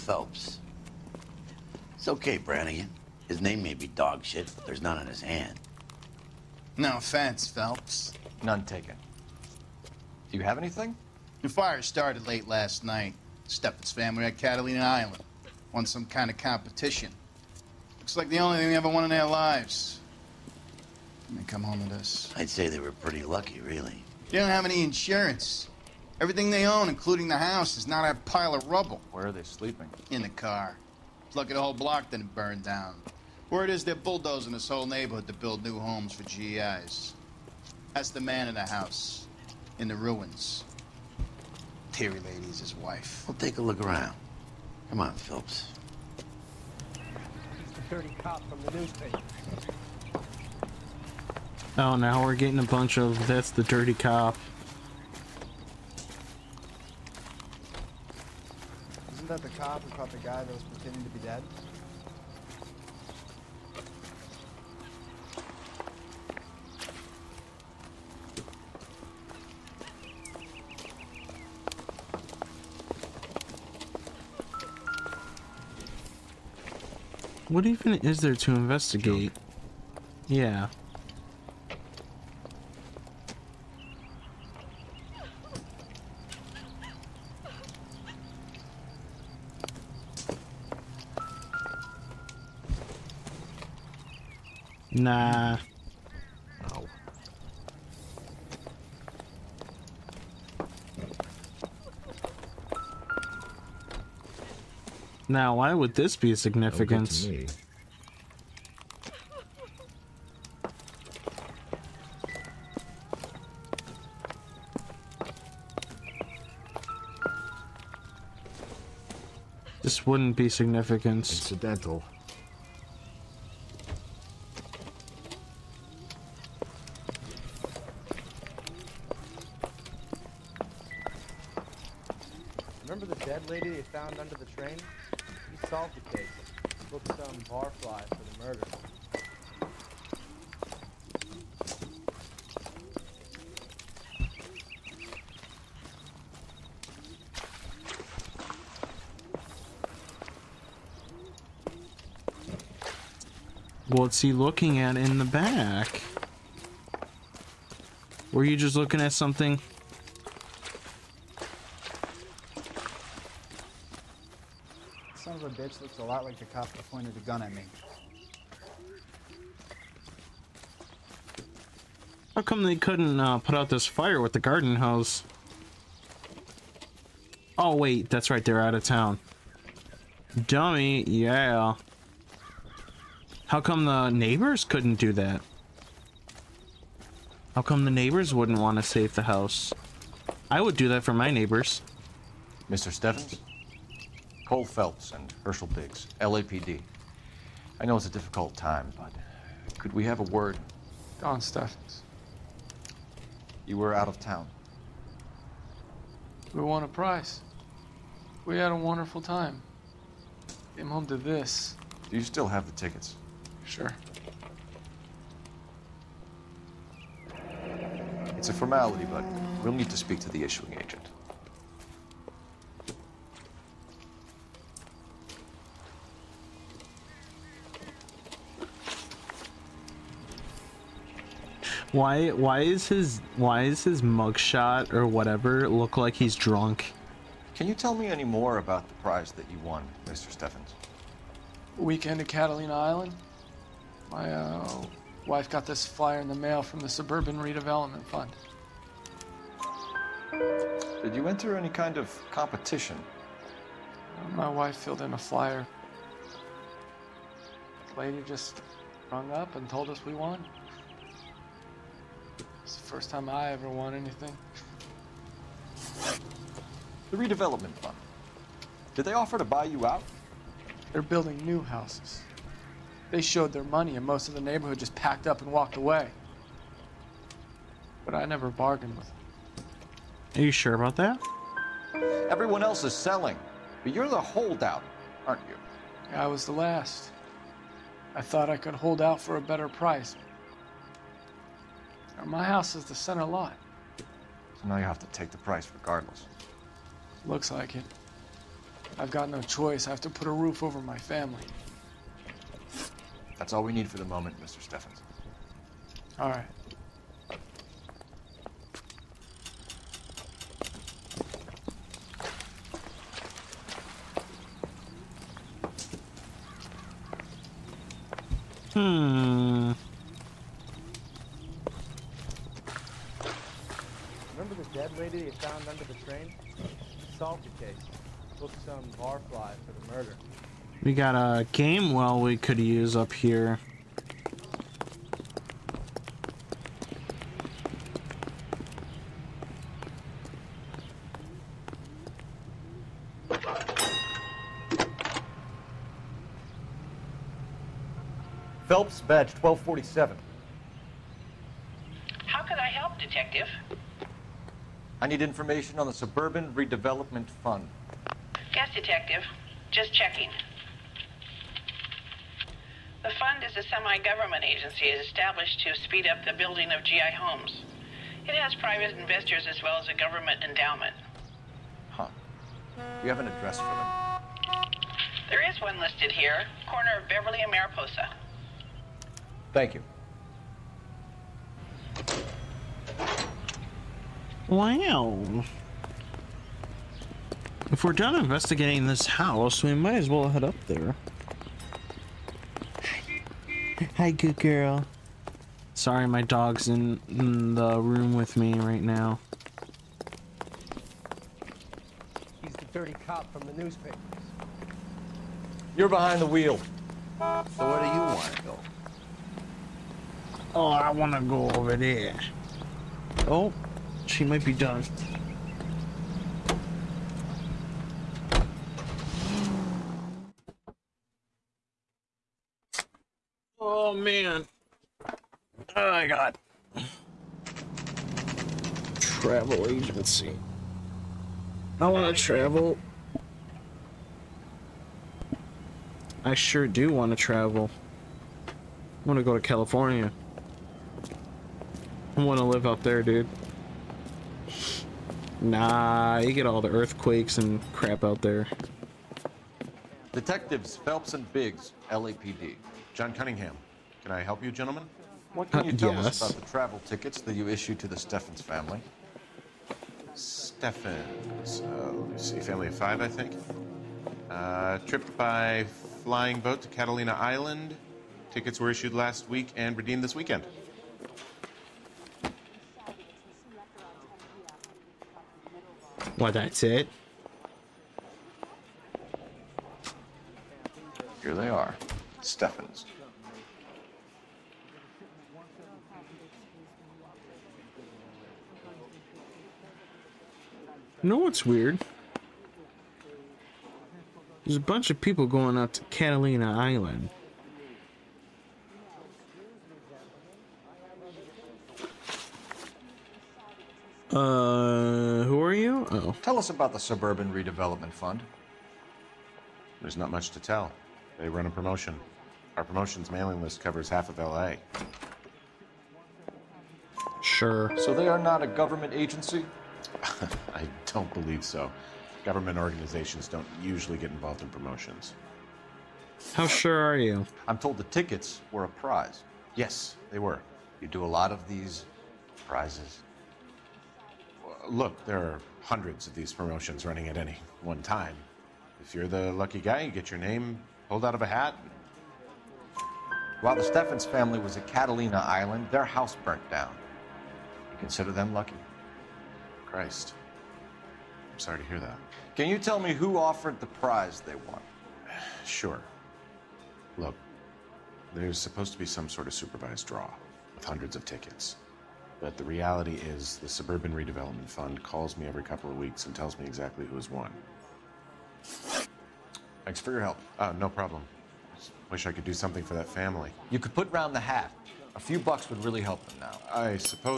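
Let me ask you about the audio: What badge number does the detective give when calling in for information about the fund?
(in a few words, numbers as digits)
1247.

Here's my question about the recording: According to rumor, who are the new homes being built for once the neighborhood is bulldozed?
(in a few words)
GIs.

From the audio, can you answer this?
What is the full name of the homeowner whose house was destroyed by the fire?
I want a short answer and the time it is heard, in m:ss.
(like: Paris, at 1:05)
Don Steffens, at 3:21.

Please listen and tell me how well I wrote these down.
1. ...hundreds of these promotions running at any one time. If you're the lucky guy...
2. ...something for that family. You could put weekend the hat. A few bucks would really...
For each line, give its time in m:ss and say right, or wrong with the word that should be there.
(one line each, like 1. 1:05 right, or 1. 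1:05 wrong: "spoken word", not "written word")
1. 8:55 right
2. 9:32 wrong: "round", not "weekend".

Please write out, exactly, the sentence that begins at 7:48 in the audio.
Tickets were issued last week and redeemed this weekend.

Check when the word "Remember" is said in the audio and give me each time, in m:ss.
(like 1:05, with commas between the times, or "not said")
2:12.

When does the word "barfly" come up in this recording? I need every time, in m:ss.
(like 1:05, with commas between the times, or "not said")
2:17, 5:28.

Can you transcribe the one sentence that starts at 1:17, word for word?
What even is there to investigate?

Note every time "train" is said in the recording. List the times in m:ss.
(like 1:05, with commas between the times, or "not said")
2:14, 5:26.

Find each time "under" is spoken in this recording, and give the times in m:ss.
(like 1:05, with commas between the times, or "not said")
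2:14, 5:25.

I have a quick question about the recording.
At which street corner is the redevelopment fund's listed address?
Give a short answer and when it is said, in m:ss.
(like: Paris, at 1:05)
Beverly and Mariposa, at 6:17.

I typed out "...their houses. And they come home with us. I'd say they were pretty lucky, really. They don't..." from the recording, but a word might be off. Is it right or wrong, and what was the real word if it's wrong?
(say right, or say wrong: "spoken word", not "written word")
wrong: "lives", not "houses".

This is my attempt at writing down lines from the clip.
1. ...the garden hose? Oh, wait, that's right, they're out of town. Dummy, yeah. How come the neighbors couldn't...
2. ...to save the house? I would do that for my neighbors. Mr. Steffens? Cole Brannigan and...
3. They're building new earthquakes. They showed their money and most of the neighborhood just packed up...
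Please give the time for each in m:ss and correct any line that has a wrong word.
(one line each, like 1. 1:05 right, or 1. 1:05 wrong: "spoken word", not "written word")
1. 2:54 right
2. 3:08 wrong: "Phelps", not "Brannigan"
3. 4:30 wrong: "houses", not "earthquakes".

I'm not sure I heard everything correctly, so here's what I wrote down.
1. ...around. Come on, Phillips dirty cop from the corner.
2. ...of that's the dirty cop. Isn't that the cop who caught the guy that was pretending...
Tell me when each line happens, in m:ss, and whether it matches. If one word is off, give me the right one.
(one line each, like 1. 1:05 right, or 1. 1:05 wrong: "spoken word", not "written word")
1. 0:43 wrong: "newspaper", not "corner"
2. 0:52 right.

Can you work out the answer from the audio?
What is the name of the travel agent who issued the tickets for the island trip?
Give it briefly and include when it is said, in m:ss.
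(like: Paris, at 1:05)
John Cunningham, at 7:32.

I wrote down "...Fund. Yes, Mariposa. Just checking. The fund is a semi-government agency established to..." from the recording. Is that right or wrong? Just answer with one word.
wrong.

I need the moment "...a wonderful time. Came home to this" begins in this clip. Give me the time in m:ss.
3:28.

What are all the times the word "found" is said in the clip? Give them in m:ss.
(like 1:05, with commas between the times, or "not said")
2:13, 5:25.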